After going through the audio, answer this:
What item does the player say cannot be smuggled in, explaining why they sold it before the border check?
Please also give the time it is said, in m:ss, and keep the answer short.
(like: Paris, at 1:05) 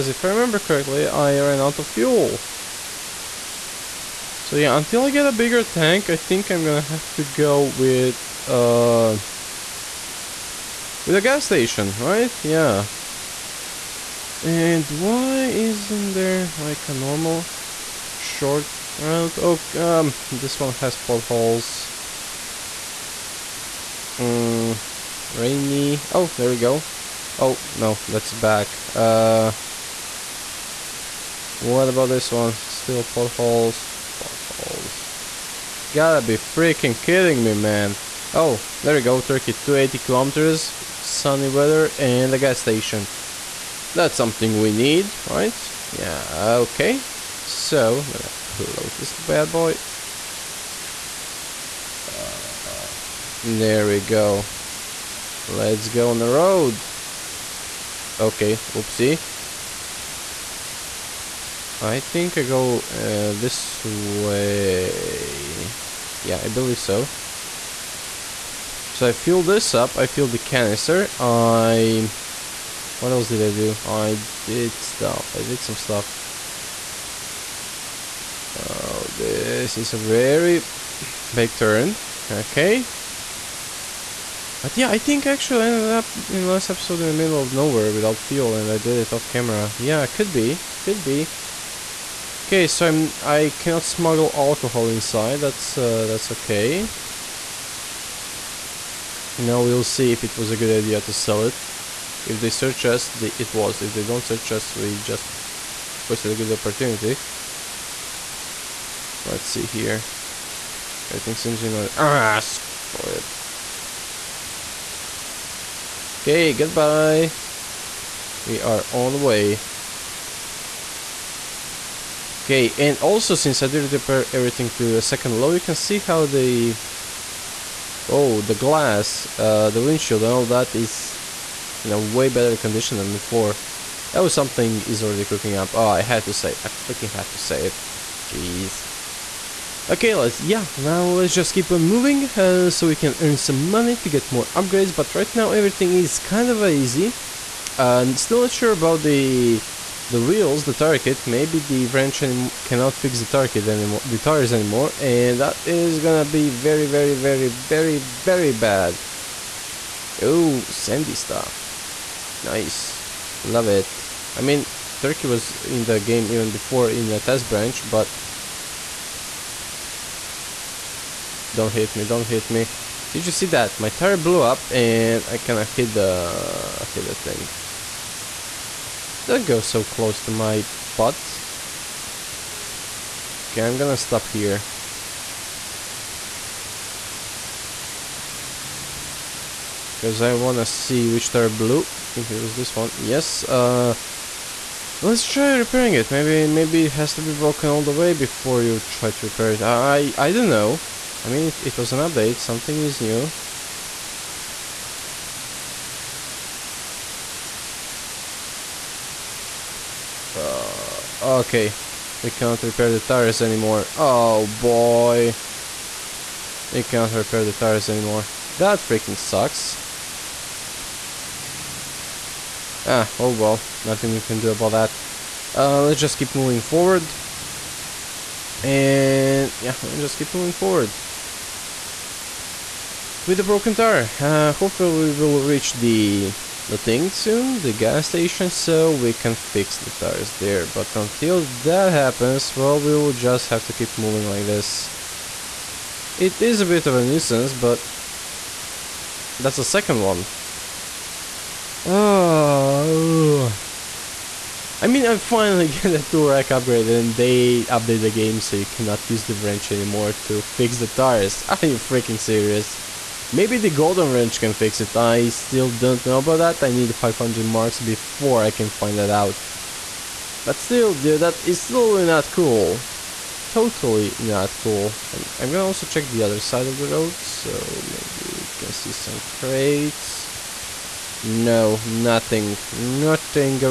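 alcohol, at 1:34.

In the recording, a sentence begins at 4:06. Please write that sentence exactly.
It is a bit of a nuisance, but that's the second one.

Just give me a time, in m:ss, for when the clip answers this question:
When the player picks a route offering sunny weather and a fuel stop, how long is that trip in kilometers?
0:39.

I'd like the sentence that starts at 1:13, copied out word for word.
I did stuff, I did some stuff.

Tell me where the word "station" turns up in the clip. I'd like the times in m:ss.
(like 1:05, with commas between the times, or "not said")
0:11, 0:42, 3:58.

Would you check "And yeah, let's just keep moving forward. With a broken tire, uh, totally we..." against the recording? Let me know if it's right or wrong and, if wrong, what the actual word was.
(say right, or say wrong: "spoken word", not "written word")
wrong: "hopefully", not "totally".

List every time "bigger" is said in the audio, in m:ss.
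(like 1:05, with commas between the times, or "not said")
0:05.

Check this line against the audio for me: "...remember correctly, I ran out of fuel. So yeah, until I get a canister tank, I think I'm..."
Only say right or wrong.
wrong.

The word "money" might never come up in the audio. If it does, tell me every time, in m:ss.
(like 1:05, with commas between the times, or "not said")
2:23.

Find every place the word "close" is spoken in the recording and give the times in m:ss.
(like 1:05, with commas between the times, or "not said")
0:48, 2:59.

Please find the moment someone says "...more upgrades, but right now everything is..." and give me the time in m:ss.
2:24.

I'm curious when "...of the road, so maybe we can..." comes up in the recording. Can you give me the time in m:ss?
4:36.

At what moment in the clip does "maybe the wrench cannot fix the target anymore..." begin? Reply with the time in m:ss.
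2:31.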